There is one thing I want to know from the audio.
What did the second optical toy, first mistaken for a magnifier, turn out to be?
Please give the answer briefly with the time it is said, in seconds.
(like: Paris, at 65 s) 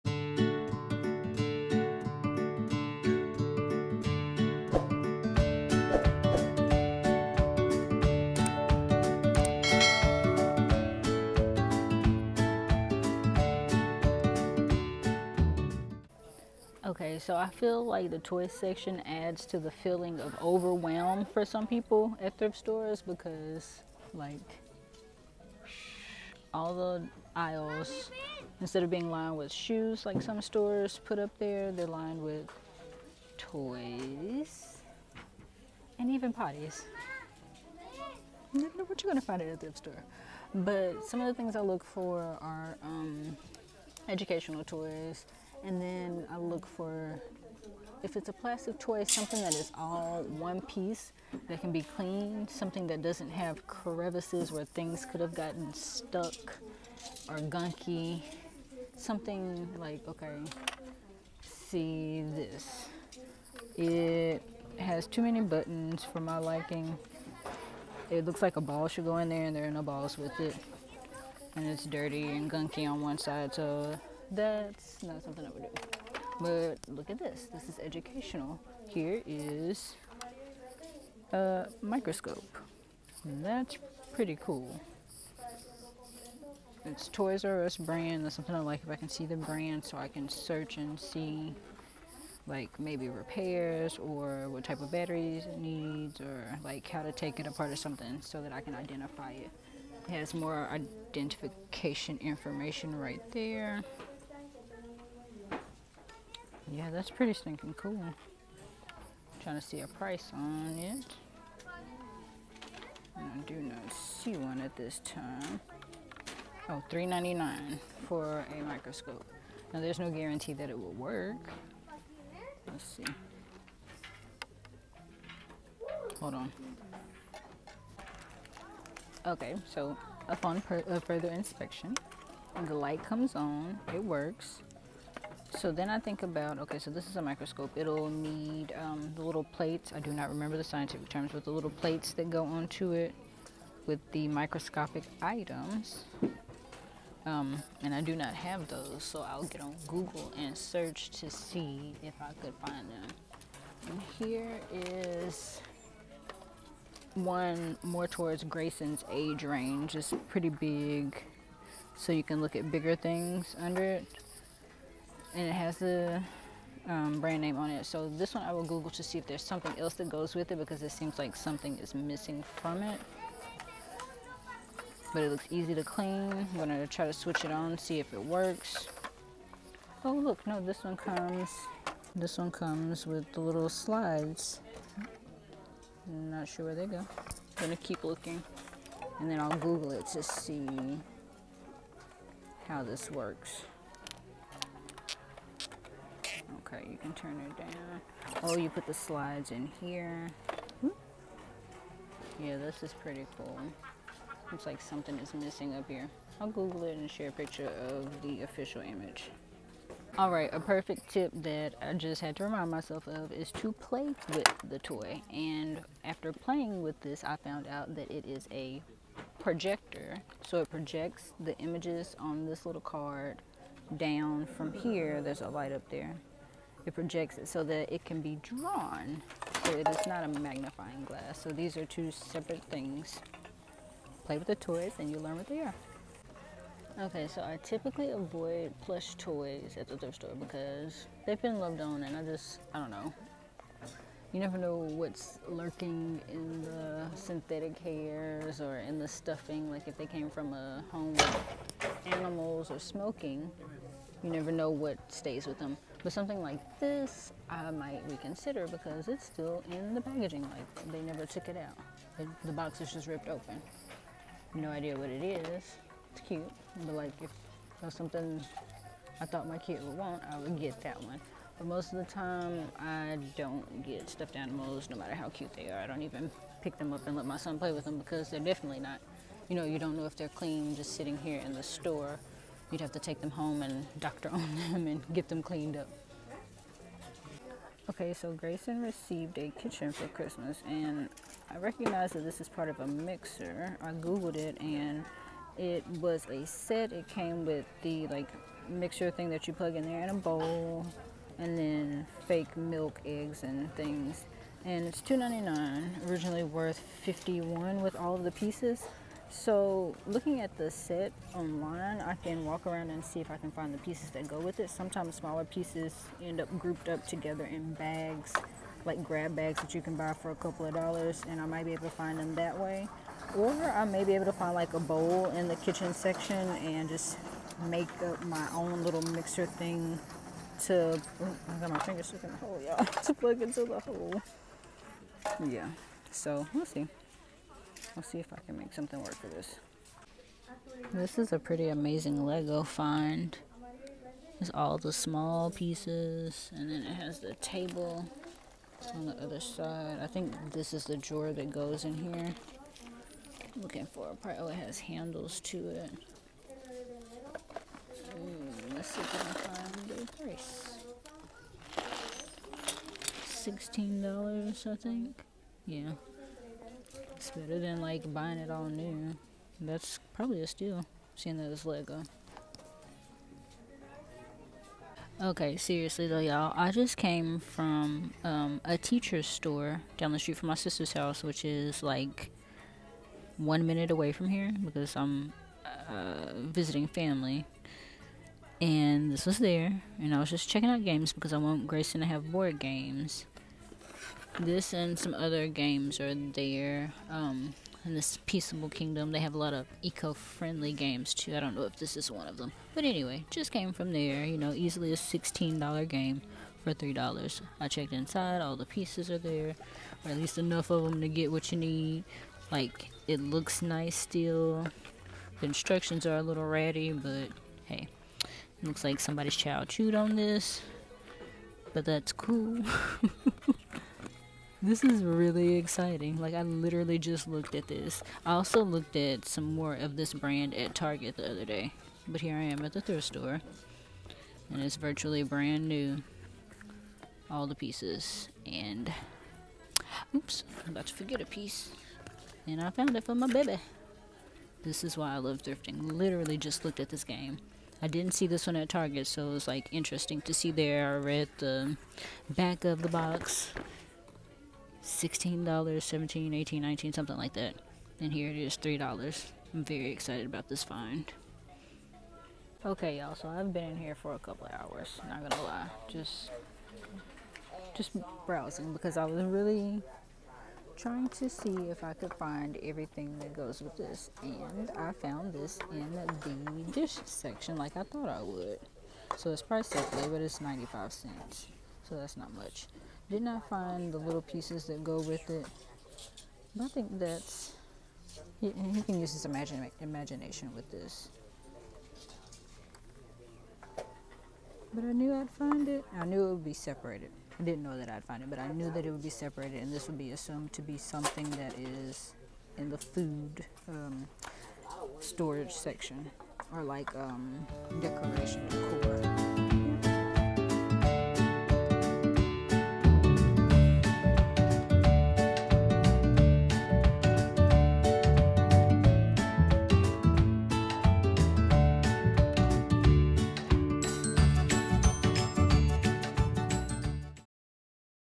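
a projector, at 218 s.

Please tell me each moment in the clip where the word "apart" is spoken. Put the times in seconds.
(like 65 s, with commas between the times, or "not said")
97 s.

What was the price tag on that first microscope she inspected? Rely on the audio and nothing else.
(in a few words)
$3.99.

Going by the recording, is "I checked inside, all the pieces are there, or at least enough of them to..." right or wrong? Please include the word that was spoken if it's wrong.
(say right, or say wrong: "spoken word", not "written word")
right.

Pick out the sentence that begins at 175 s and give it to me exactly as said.
But it looks easy to clean.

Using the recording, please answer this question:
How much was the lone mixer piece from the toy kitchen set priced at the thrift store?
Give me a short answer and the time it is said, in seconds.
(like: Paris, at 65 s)
$2.99, at 305 s.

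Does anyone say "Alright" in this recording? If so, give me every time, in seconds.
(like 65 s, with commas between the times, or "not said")
210 s.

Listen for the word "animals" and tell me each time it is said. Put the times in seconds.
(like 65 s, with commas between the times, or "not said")
252 s, 274 s.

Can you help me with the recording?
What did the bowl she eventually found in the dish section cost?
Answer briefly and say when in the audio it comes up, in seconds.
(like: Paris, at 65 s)
95 cents, at 480 s.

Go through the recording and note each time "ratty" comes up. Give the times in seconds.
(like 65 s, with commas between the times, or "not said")
416 s.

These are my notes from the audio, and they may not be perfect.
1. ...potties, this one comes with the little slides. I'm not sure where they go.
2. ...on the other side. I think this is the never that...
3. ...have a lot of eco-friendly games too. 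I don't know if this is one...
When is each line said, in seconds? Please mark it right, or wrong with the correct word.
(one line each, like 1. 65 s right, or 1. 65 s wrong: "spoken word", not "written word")
1. 180 s wrong: "comes", not "potties"
2. 348 s wrong: "drawer", not "never"
3. 399 s right.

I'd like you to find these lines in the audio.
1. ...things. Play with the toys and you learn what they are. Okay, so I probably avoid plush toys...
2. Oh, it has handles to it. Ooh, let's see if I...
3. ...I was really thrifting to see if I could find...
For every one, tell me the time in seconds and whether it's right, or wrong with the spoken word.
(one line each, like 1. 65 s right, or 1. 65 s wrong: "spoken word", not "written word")
1. 232 s wrong: "typically", not "probably"
2. 354 s right
3. 468 s wrong: "trying", not "thrifting".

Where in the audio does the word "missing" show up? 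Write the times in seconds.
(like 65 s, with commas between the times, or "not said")
171 s, 205 s.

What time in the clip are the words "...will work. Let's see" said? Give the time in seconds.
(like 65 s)
120 s.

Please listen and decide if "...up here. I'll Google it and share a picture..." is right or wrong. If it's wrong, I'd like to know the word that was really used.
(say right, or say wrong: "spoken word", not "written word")
right.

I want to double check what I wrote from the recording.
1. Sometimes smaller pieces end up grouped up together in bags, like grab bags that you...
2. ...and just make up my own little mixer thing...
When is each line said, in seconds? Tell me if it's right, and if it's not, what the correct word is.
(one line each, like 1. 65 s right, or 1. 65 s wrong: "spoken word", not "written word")
1. 314 s right
2. 326 s right.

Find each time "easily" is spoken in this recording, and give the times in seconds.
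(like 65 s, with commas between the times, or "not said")
404 s.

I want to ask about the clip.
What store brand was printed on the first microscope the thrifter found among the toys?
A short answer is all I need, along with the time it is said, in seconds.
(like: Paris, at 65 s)
Toys R Us, at 87 s.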